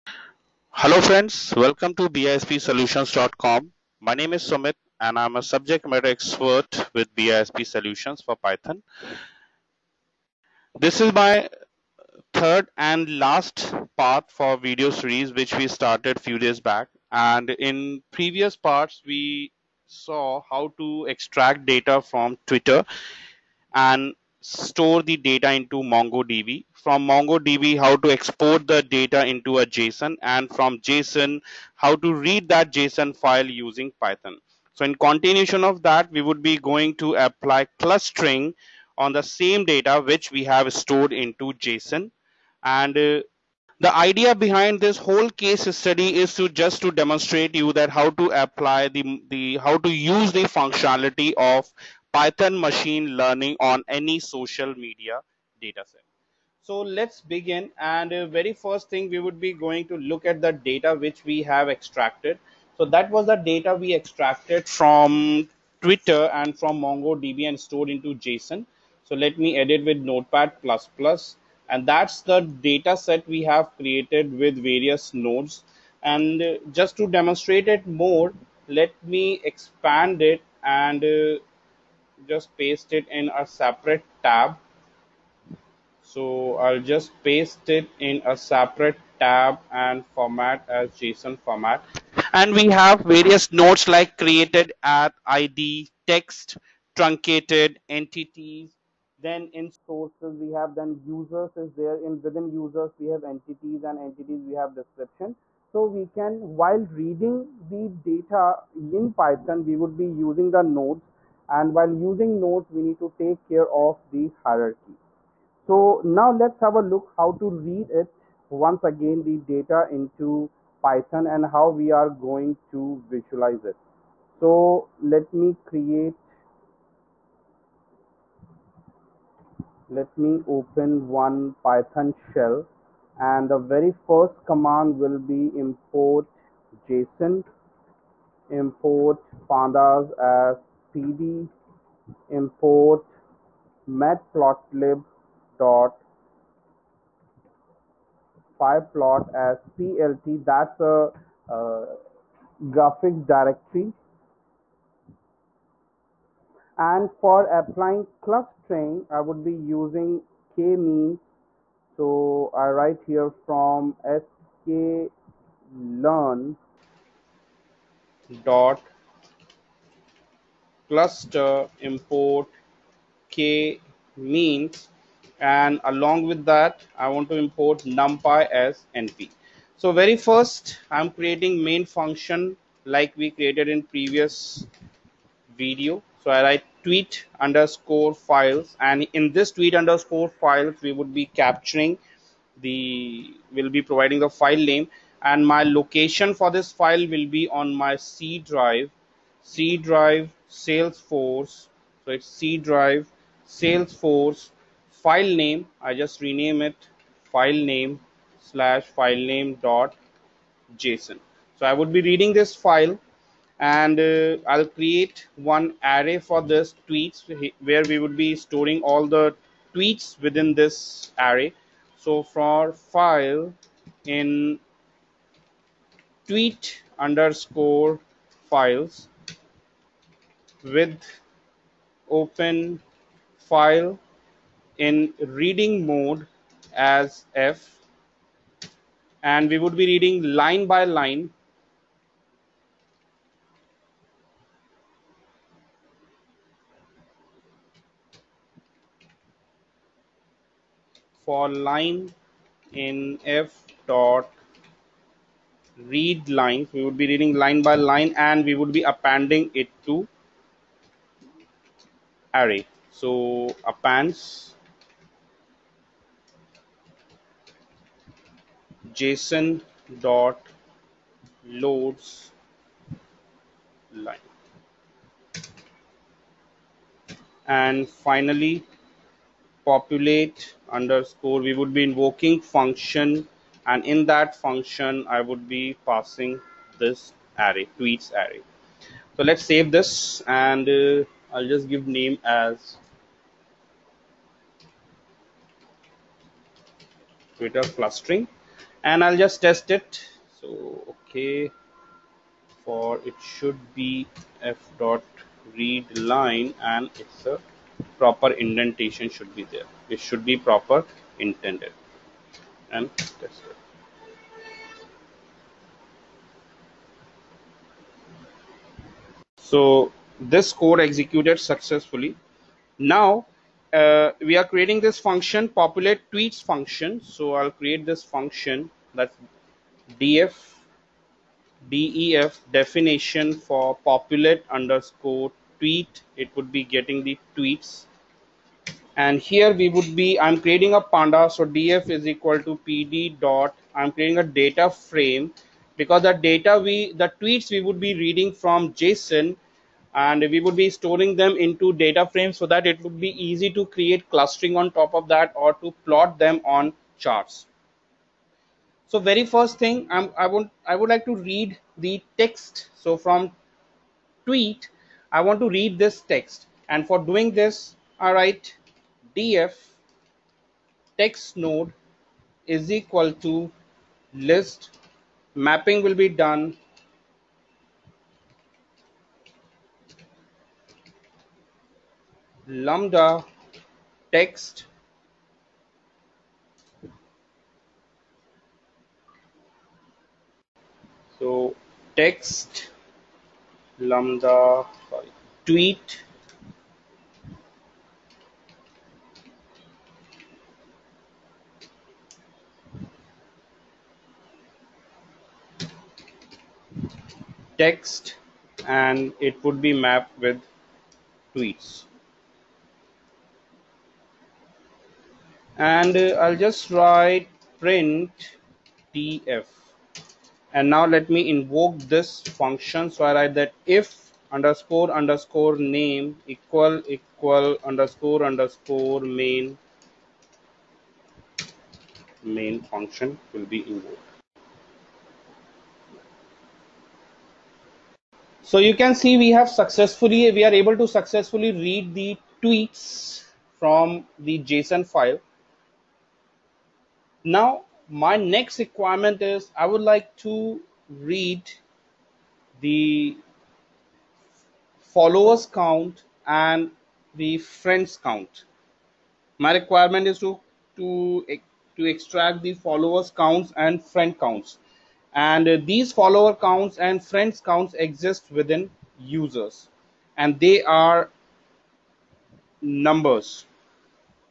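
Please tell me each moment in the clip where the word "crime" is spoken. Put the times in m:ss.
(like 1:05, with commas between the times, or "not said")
not said.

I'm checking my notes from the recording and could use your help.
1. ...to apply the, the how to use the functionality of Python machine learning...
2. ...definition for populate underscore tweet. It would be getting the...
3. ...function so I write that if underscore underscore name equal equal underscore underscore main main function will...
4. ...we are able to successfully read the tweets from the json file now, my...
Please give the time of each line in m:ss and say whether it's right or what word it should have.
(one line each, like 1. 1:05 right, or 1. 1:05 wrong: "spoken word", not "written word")
1. 0:48 right
2. 5:32 right
3. 7:02 right
4. 7:20 right.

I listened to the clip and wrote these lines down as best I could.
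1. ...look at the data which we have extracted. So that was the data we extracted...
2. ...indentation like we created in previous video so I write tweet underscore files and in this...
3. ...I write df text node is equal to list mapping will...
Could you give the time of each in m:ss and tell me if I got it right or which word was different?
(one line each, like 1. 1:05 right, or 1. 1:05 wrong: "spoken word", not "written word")
1. 0:59 right
2. 3:01 wrong: "function", not "indentation"
3. 6:07 right.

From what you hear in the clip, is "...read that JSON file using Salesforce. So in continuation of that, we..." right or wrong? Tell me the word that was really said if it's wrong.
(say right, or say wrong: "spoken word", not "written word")
wrong: "Python", not "Salesforce".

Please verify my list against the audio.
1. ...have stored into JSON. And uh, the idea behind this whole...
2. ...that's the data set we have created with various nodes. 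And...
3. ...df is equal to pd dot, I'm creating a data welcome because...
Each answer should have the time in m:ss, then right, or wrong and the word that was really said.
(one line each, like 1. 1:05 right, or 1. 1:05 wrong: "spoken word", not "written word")
1. 0:40 right
2. 1:11 right
3. 5:41 wrong: "frame", not "welcome".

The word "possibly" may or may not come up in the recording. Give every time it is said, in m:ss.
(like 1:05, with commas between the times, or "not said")
not said.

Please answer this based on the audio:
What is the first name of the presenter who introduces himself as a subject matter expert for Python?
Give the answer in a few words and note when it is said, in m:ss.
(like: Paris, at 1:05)
Sumit, at 0:04.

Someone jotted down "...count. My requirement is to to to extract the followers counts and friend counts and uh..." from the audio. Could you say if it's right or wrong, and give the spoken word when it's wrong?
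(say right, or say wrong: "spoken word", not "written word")
right.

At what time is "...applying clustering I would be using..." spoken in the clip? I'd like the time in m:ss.
2:37.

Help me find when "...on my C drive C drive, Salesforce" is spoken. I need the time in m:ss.
3:17.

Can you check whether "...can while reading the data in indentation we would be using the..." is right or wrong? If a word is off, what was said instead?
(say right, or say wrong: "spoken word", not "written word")
wrong: "python", not "indentation".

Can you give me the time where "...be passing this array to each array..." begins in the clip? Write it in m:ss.
4:45.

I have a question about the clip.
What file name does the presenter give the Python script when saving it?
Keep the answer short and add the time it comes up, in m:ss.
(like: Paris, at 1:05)
Twitter clustering, at 4:57.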